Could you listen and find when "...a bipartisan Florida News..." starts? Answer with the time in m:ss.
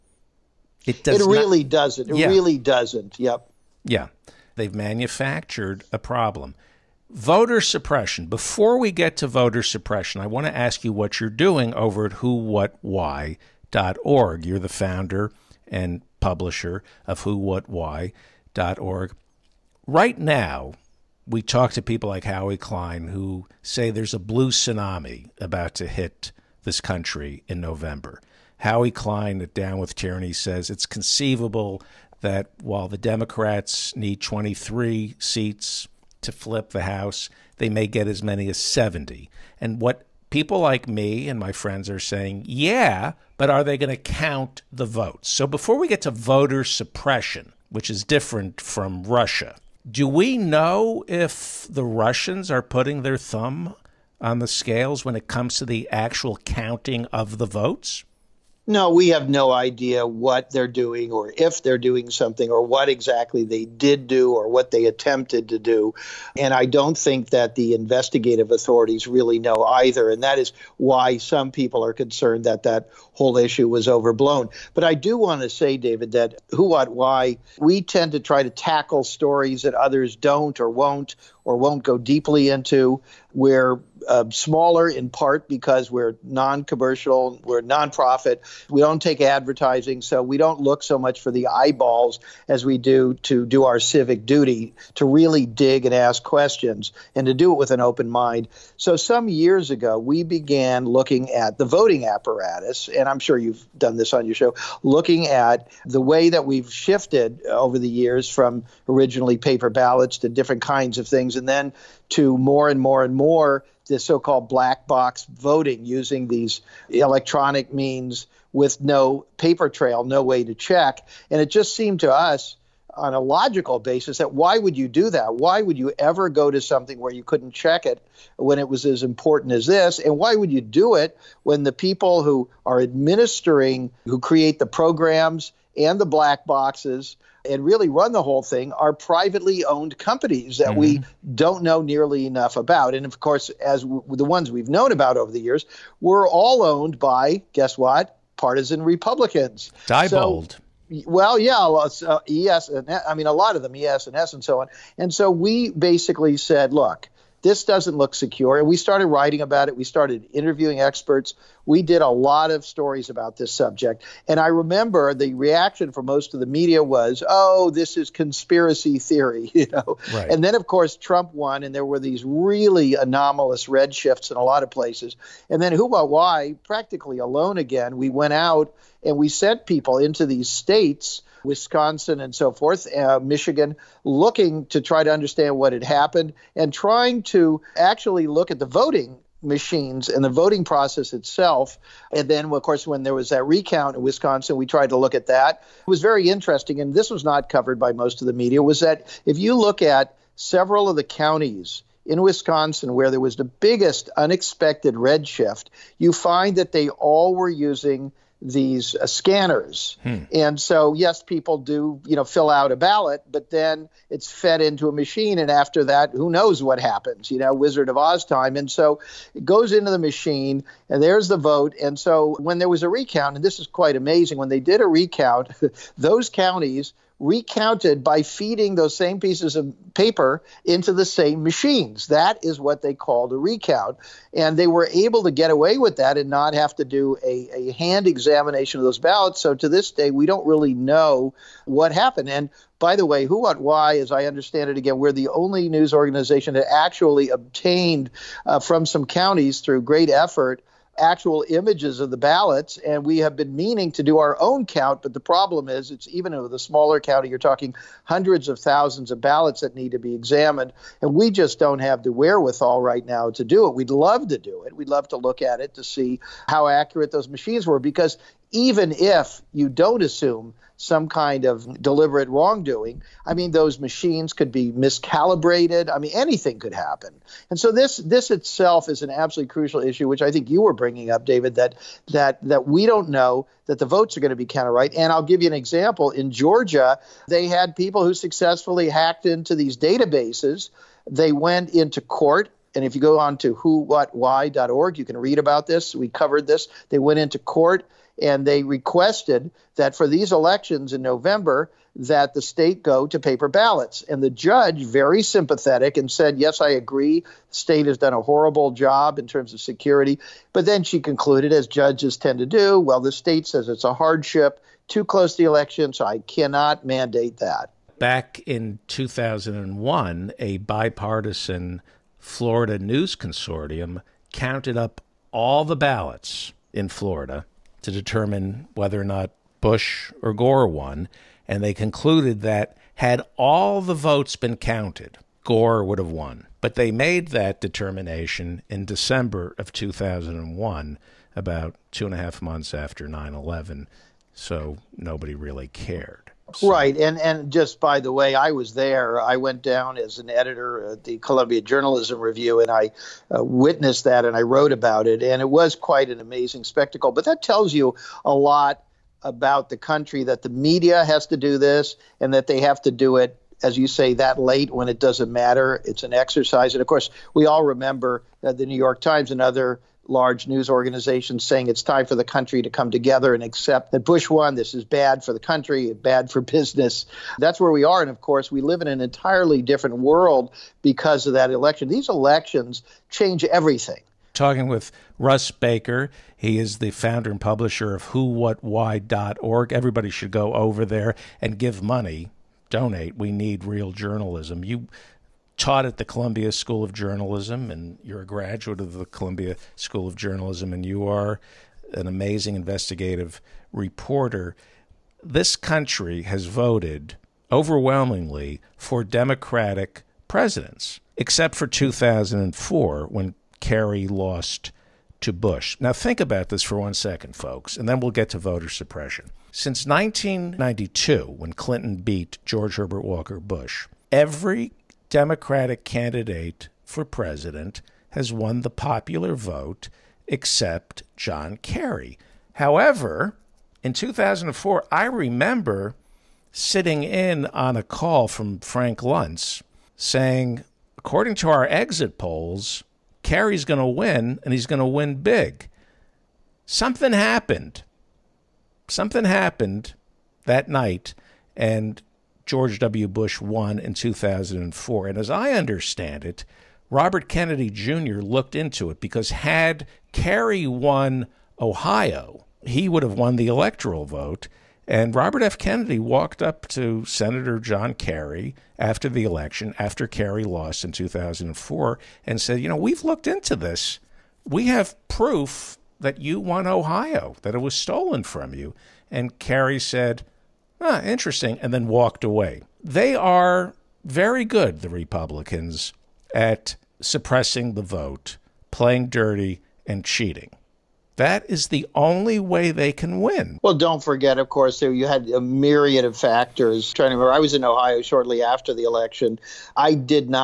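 5:20.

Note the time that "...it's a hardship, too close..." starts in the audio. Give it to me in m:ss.
5:13.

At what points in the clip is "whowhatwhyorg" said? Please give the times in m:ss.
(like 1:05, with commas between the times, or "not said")
0:12, 0:17, 4:53, 6:28.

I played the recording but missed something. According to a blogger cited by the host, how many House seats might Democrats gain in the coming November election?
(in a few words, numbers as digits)
70.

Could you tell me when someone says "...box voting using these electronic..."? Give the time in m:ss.
1:54.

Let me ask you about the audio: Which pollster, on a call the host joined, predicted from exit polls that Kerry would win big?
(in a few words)
Frank Luntz.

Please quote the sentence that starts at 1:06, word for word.
And I don't think that the investigative authorities really know either.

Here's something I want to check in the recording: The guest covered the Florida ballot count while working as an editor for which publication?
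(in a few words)
Columbia Journalism Review.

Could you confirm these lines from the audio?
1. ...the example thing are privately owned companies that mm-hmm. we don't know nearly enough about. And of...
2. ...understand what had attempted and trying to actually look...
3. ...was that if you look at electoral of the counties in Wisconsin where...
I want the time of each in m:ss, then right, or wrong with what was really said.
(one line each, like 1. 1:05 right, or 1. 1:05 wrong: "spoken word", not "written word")
1. 2:18 wrong: "whole", not "example"
2. 3:05 wrong: "happened", not "attempted"
3. 3:18 wrong: "several", not "electoral".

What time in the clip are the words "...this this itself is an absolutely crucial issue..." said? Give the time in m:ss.
4:37.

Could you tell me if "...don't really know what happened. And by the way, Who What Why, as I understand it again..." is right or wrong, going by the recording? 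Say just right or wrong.
right.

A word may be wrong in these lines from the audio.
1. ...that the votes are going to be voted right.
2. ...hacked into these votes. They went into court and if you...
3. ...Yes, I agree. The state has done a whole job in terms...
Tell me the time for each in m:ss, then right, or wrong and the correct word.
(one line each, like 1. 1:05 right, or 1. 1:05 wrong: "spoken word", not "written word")
1. 4:43 wrong: "counted", not "voted"
2. 4:48 wrong: "databases", not "votes"
3. 5:06 wrong: "horrible", not "whole".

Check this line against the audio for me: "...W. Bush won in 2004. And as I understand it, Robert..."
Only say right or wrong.
right.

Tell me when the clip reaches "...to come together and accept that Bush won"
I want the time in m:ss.
6:12.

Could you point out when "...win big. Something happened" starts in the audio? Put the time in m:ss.
7:24.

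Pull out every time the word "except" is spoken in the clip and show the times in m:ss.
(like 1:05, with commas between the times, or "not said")
6:51, 7:10.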